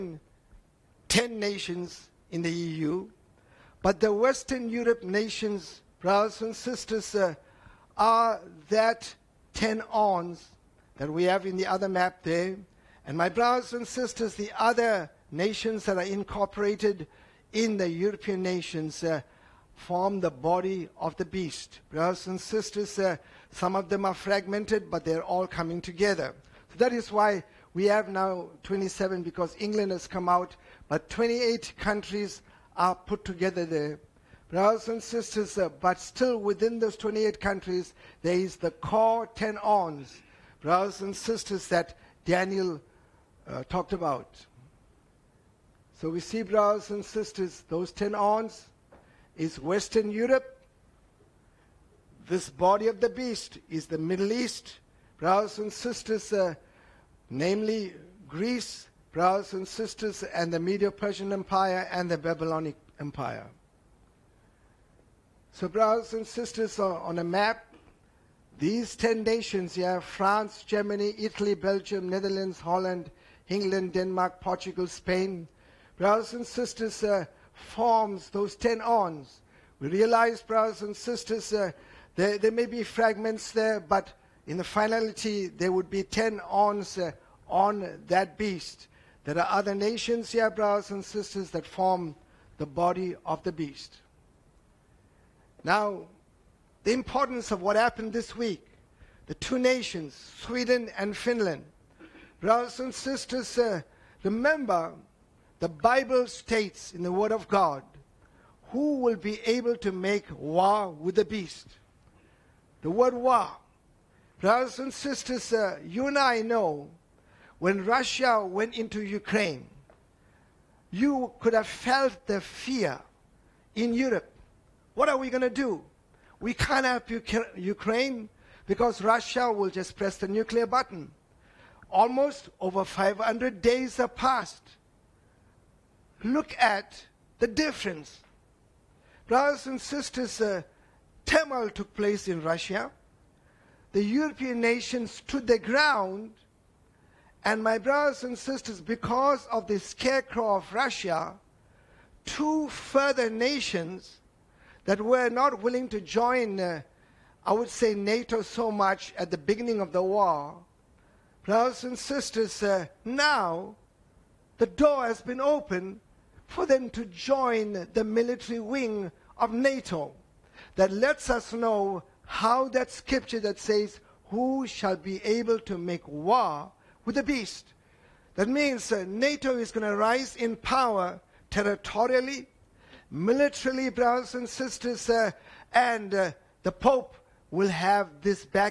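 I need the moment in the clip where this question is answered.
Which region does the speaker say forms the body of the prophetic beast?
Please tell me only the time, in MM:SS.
00:53.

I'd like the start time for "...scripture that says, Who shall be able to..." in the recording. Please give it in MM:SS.
02:52.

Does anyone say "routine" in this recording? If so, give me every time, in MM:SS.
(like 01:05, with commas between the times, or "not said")
not said.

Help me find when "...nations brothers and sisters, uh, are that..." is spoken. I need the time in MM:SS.
00:05.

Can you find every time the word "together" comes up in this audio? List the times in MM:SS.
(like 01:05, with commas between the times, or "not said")
00:25, 00:33.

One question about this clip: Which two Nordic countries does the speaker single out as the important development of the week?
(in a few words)
Sweden and Finland.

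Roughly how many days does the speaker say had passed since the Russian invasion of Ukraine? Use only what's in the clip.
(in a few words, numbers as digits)
500.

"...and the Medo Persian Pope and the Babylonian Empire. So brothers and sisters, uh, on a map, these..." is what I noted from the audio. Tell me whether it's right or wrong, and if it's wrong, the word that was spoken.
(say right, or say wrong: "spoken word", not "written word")
wrong: "Empire", not "Pope".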